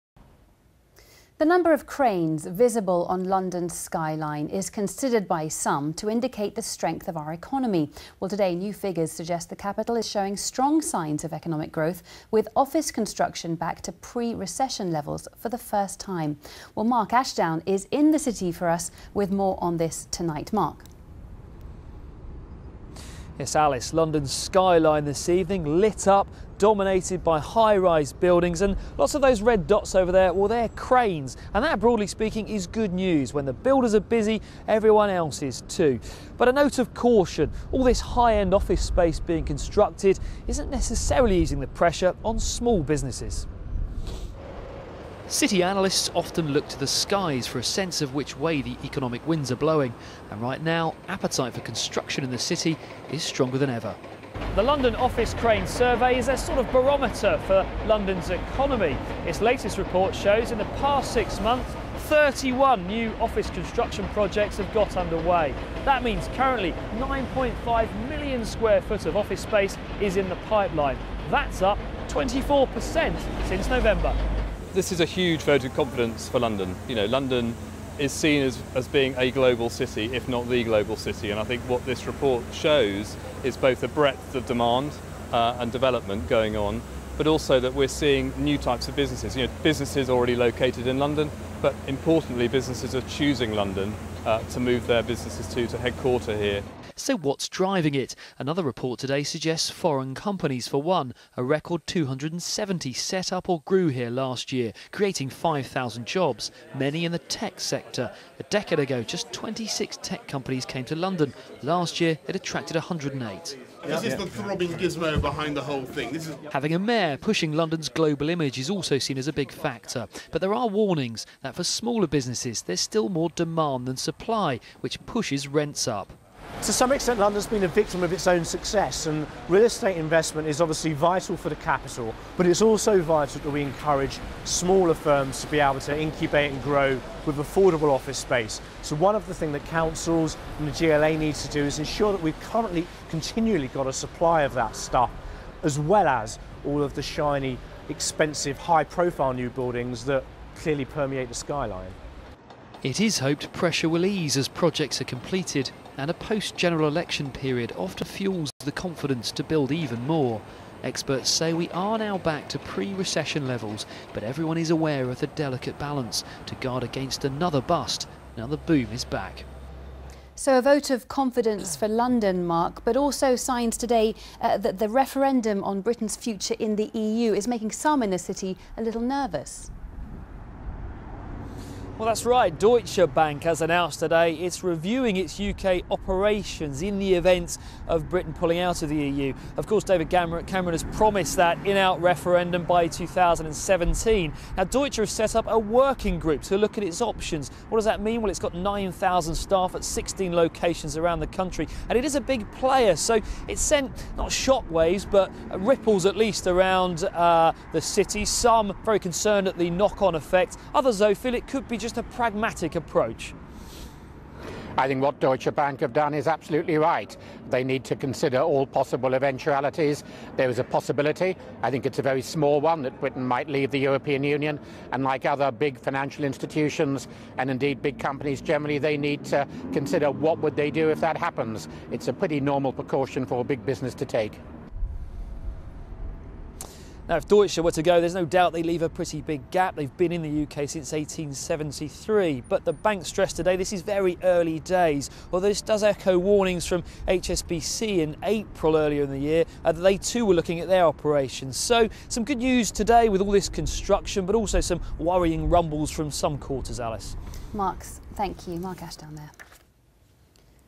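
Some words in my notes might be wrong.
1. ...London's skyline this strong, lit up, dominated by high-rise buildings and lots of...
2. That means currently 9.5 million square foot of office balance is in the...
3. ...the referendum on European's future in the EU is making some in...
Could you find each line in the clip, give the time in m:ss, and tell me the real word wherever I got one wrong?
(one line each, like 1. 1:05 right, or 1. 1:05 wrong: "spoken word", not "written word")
1. 0:23 wrong: "evening", not "strong"
2. 1:05 wrong: "space", not "balance"
3. 2:54 wrong: "Britain", not "European".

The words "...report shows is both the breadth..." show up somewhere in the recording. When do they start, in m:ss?
1:22.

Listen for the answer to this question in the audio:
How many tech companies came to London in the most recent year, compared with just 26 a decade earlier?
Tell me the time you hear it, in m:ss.
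1:52.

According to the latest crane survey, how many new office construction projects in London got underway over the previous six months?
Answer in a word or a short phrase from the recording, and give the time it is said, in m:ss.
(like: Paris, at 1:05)
31, at 1:02.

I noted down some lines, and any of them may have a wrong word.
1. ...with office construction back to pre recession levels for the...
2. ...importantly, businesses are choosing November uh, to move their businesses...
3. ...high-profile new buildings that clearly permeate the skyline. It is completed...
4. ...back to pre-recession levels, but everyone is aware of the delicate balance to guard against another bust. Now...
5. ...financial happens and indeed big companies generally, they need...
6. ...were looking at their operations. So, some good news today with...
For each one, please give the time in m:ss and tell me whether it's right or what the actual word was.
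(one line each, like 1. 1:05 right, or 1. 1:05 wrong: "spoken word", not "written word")
1. 0:12 right
2. 1:31 wrong: "London", not "November"
3. 2:28 wrong: "hoped", not "completed"
4. 2:42 right
5. 3:45 wrong: "institutions", not "happens"
6. 4:10 right.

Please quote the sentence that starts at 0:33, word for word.
When the builders are busy, everyone else is too.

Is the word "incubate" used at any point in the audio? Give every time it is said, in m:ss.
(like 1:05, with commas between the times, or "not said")
2:15.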